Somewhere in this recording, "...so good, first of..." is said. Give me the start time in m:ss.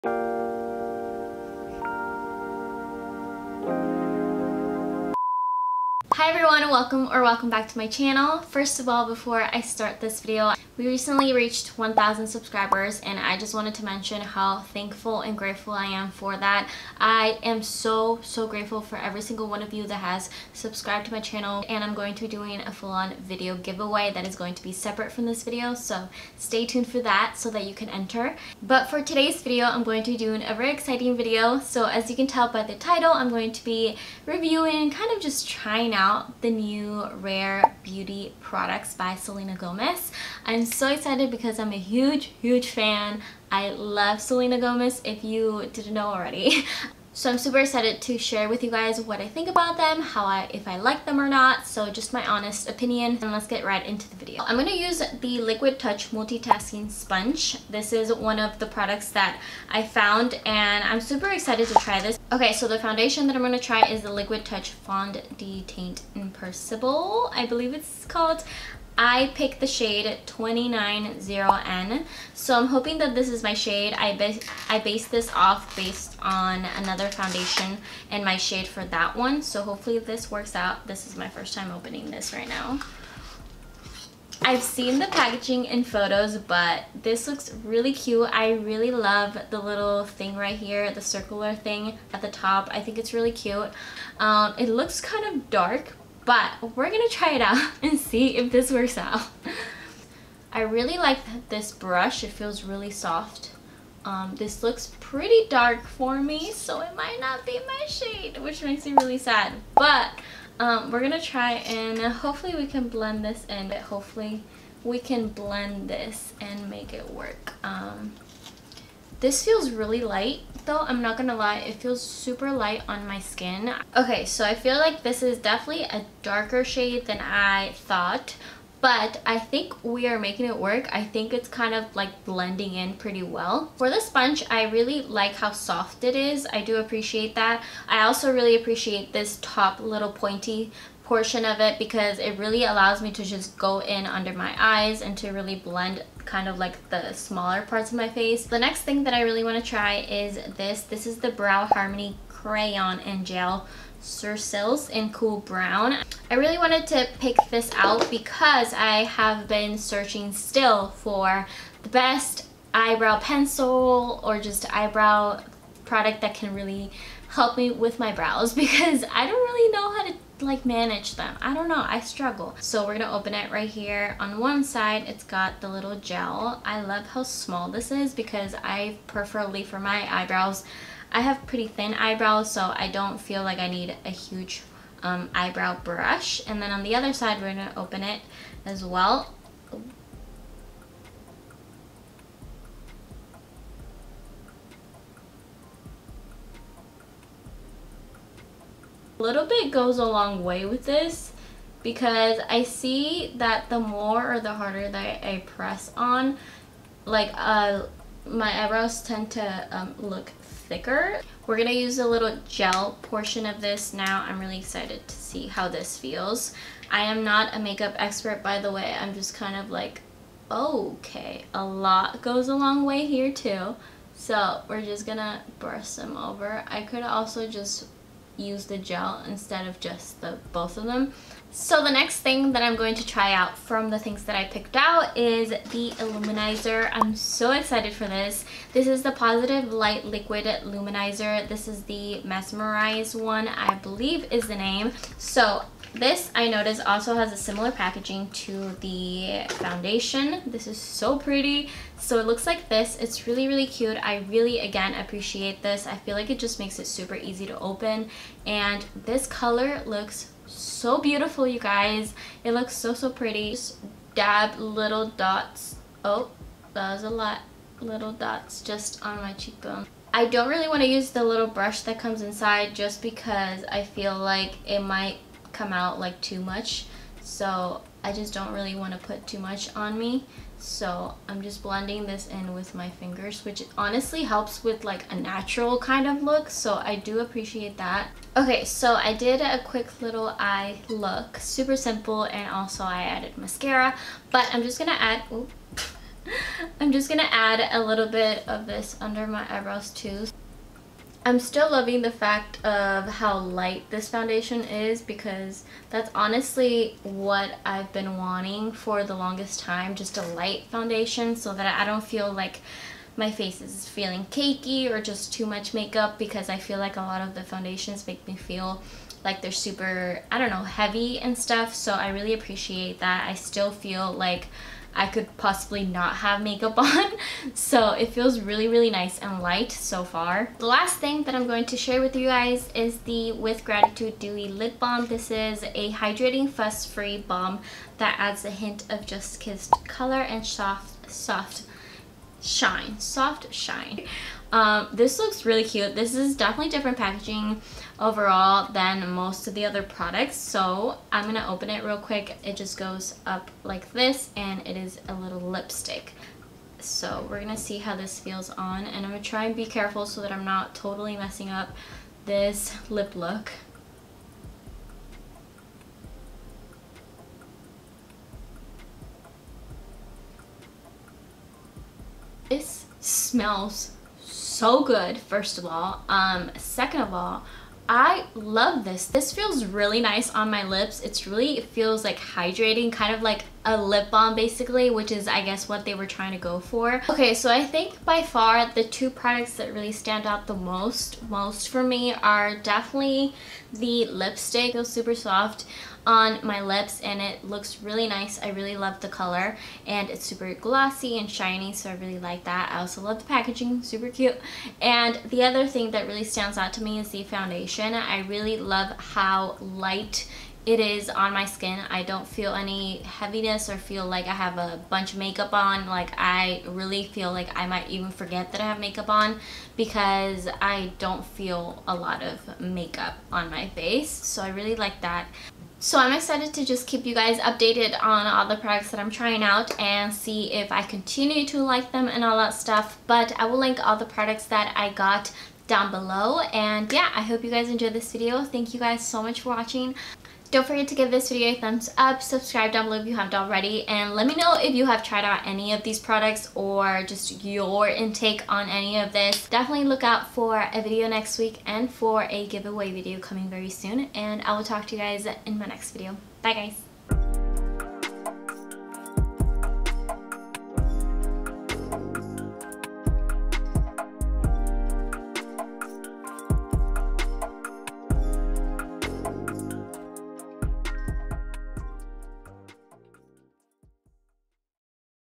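6:14.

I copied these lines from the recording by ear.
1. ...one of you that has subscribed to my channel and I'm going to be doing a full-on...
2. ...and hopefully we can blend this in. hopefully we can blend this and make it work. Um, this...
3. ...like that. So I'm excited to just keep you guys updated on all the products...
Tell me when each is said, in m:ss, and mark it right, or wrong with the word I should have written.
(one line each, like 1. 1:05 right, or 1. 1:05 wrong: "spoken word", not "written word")
1. 0:19 right
2. 1:51 right
3. 7:04 right.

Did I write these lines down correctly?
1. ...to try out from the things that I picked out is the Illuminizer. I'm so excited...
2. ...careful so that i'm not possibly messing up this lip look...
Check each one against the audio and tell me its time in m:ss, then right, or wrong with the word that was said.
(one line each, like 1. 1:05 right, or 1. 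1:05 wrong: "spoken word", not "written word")
1. 3:52 right
2. 5:59 wrong: "totally", not "possibly".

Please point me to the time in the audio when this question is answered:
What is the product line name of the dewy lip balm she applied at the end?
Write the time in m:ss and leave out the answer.
5:33.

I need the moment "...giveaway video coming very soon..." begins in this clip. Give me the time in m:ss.
7:32.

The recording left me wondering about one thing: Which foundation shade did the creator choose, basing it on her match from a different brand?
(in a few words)
290N.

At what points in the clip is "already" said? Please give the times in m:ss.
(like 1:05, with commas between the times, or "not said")
0:46, 7:23.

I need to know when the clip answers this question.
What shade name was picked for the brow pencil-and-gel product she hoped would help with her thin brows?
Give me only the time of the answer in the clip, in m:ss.
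2:35.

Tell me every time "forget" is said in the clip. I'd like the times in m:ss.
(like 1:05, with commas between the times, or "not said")
6:58, 7:20.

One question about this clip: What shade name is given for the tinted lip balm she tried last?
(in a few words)
Just Kissed.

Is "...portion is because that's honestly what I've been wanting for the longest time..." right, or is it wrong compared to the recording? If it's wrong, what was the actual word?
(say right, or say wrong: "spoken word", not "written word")
wrong: "foundation", not "portion".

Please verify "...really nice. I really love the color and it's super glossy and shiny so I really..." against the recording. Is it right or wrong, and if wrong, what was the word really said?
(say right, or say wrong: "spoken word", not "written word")
right.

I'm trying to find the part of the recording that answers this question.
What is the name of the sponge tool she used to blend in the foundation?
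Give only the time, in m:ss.
0:55.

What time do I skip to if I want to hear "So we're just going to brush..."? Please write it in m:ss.
3:44.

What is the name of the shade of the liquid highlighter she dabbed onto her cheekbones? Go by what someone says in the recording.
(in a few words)
Mesmerize.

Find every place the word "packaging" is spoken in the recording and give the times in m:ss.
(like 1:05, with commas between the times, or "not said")
1:25, 4:07, 5:46, 6:43.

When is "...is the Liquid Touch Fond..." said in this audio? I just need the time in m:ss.
1:03.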